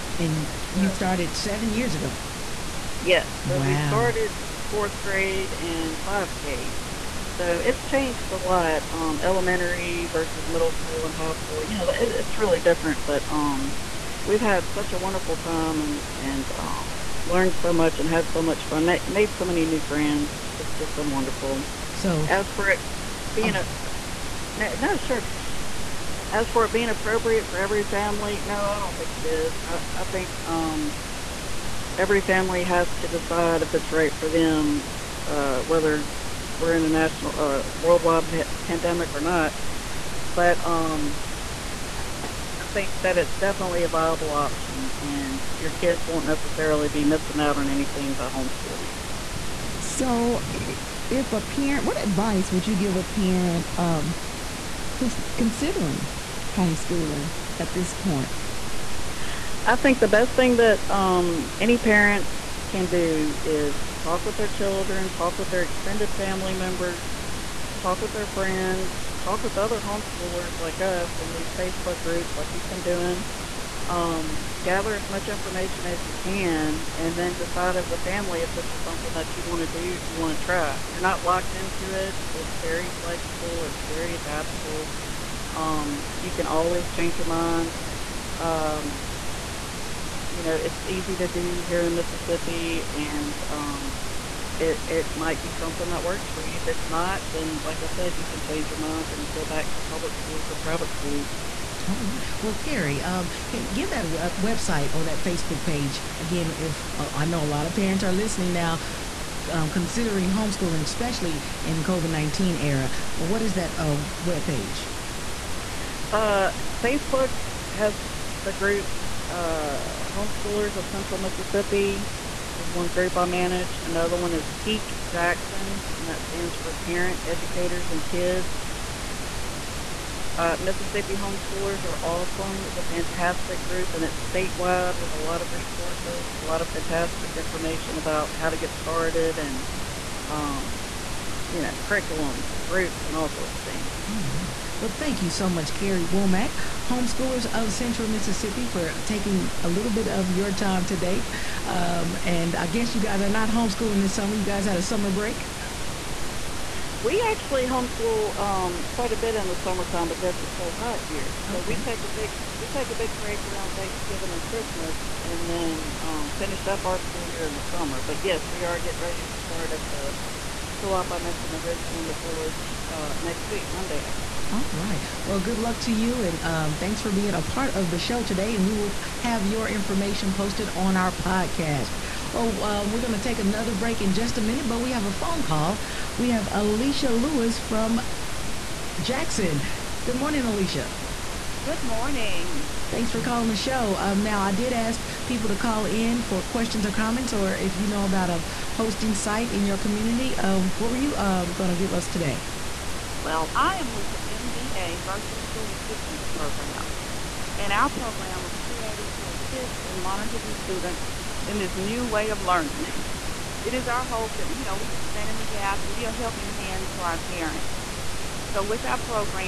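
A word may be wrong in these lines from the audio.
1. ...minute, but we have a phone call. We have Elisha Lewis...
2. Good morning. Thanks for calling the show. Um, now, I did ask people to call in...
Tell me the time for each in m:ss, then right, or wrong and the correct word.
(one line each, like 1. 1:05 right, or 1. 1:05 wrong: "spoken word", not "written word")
1. 3:04 right
2. 3:11 right.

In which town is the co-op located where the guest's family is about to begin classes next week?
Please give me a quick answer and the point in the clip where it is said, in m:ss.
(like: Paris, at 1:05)
Ridgeland, at 2:51.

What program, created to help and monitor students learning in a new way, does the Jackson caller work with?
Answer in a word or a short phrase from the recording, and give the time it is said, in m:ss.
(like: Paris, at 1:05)
MBA Virtual School Assistance Program, at 3:24.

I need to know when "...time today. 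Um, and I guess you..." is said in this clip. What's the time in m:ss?
2:30.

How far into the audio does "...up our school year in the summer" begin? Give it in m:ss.
2:46.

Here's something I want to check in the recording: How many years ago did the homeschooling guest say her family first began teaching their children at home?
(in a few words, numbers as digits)
7.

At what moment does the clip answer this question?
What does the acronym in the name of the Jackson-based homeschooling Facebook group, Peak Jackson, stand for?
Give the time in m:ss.
2:06.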